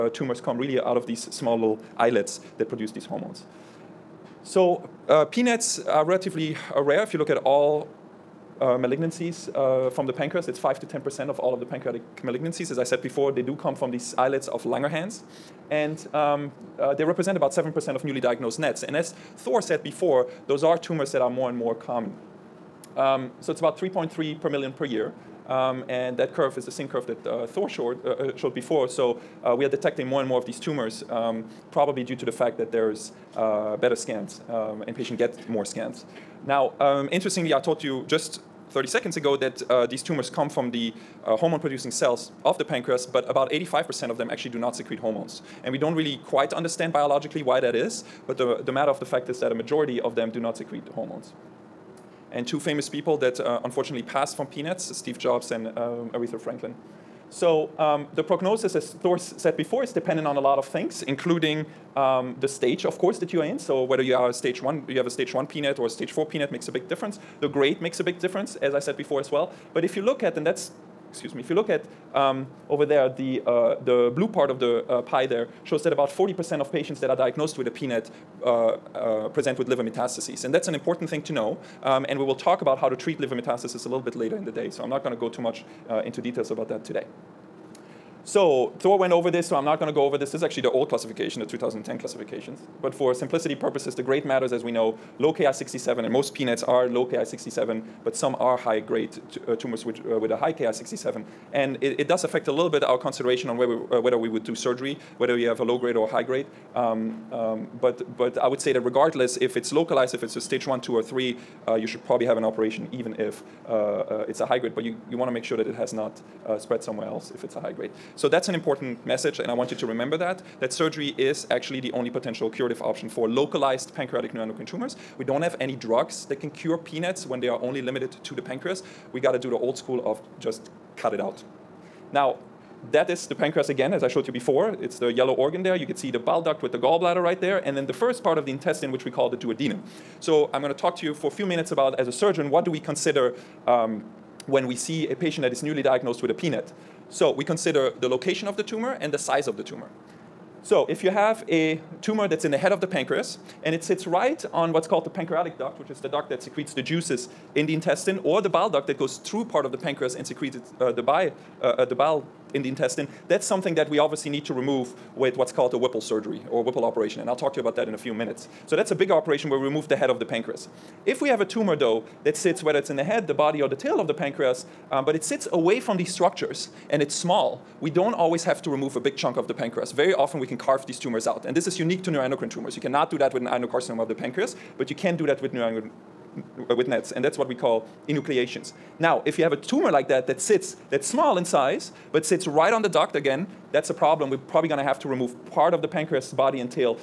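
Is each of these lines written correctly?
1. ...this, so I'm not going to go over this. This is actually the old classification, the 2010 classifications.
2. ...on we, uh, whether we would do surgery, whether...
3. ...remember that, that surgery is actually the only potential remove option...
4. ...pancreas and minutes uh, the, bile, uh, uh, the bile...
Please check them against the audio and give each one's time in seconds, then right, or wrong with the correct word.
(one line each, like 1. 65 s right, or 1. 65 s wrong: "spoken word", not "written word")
1. 89 s right
2. 103 s right
3. 119 s wrong: "curative", not "remove"
4. 159 s wrong: "secretes", not "minutes".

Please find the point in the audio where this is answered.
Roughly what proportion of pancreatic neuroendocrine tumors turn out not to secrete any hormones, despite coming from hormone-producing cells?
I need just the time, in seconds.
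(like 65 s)
43 s.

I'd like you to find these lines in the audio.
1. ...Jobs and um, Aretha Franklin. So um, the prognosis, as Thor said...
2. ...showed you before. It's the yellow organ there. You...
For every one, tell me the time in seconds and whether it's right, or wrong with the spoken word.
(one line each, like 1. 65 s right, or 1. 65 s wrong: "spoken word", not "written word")
1. 55 s right
2. 134 s right.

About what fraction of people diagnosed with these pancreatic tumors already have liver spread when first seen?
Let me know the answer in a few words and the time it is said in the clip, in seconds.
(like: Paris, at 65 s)
40%, at 76 s.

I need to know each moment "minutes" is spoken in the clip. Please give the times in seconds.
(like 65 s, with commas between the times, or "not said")
141 s, 168 s.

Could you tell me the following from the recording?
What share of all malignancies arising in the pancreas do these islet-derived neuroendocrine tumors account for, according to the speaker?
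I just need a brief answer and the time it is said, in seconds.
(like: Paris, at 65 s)
5 to 10%, at 10 s.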